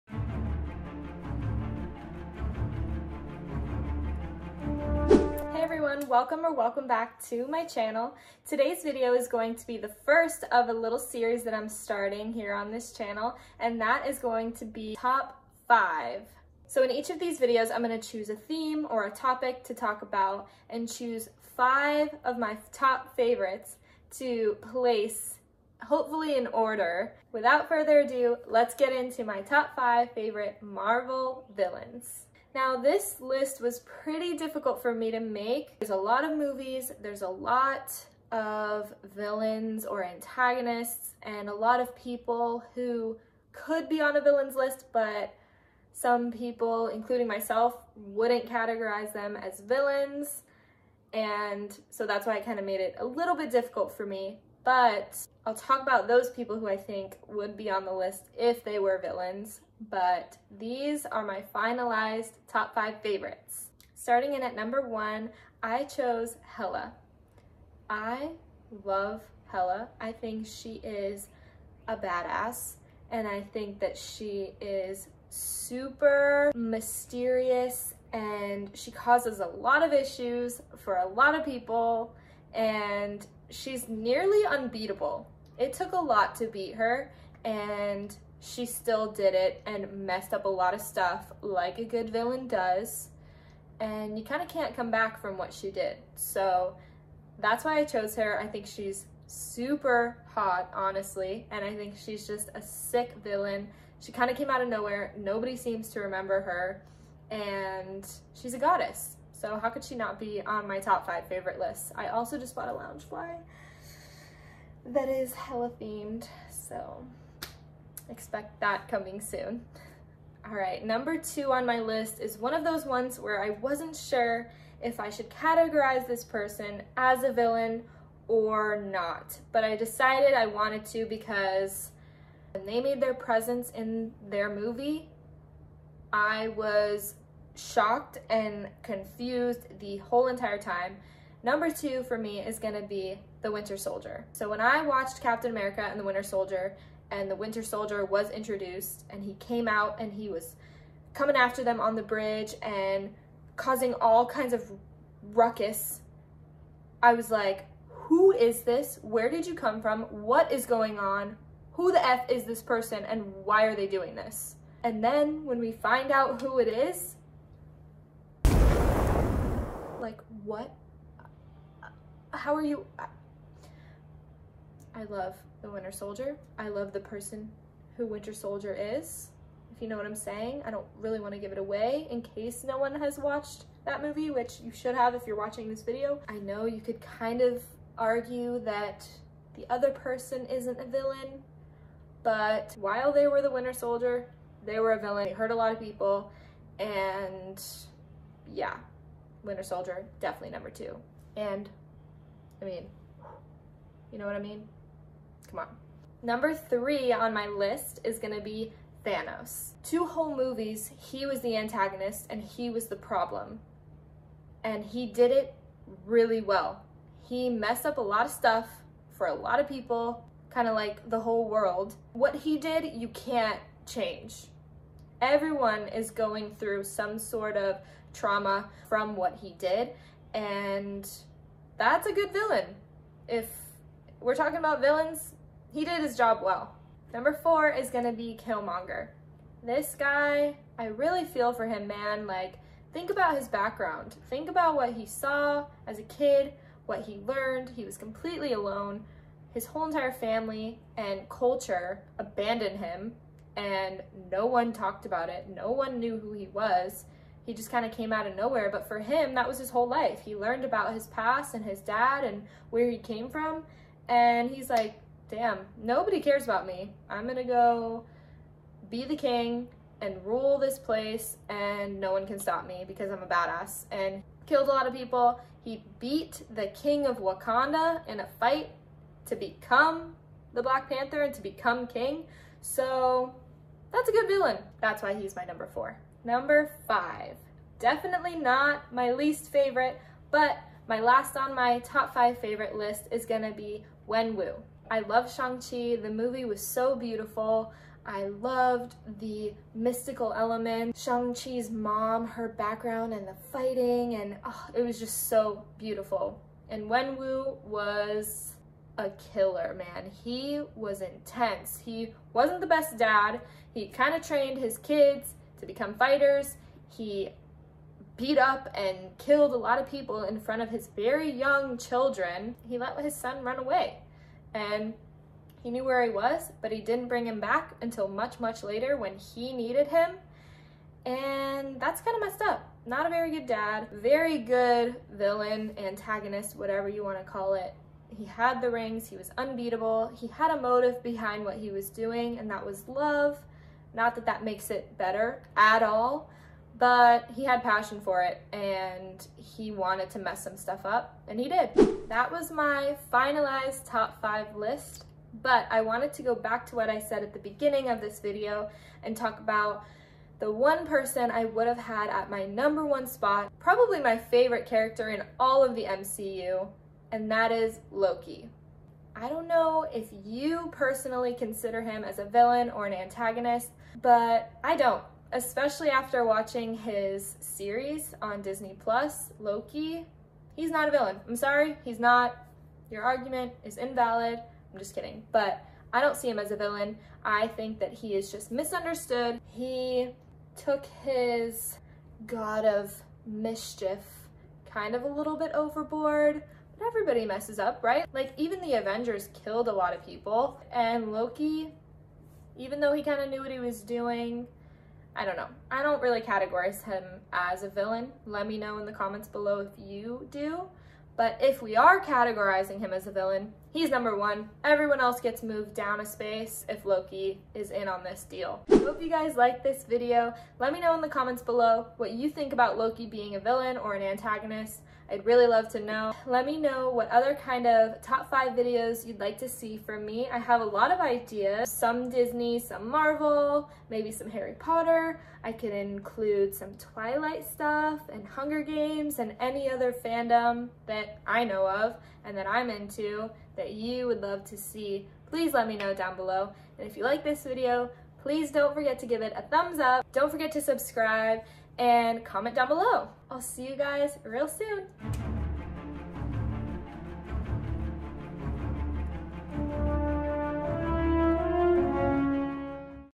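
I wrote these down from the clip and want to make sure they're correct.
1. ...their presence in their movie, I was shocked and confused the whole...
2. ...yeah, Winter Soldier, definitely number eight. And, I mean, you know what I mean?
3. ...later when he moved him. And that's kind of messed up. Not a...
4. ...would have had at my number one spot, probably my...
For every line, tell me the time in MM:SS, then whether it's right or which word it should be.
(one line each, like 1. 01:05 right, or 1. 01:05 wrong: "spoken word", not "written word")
1. 02:13 right
2. 03:18 wrong: "two", not "eight"
3. 05:28 wrong: "needed", not "moved"
4. 06:01 right.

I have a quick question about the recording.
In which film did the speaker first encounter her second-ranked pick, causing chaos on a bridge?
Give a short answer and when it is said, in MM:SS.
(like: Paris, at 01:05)
Captain America and The Winter Soldier, at 02:25.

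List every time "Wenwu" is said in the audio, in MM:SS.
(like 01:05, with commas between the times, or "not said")
04:54, 05:06.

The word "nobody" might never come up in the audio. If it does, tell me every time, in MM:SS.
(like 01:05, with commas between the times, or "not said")
01:45, 04:25.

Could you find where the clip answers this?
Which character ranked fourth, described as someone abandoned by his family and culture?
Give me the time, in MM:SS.
03:58.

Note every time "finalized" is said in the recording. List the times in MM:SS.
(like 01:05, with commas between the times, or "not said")
01:01, 05:53.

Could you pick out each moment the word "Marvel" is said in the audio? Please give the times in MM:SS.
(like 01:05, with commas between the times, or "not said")
00:30, 07:12.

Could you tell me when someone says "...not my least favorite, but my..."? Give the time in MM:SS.
04:48.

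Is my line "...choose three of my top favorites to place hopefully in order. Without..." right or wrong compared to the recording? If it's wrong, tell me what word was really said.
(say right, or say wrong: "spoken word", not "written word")
wrong: "five", not "three".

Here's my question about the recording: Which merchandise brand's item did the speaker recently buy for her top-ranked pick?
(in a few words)
Loungefly.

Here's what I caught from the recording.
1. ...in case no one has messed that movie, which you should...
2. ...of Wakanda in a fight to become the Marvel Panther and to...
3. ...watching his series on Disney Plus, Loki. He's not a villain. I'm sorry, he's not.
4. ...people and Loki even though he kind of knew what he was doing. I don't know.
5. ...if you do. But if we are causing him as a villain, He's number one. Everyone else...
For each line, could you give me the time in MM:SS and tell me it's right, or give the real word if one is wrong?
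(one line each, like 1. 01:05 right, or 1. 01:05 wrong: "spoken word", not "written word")
1. 03:02 wrong: "watched", not "messed"
2. 04:37 wrong: "Black", not "Marvel"
3. 06:16 right
4. 06:40 right
5. 06:49 wrong: "categorizing", not "causing".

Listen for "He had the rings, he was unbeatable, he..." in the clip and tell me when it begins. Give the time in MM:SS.
05:38.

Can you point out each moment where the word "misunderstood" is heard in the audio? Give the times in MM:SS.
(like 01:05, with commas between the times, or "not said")
06:28.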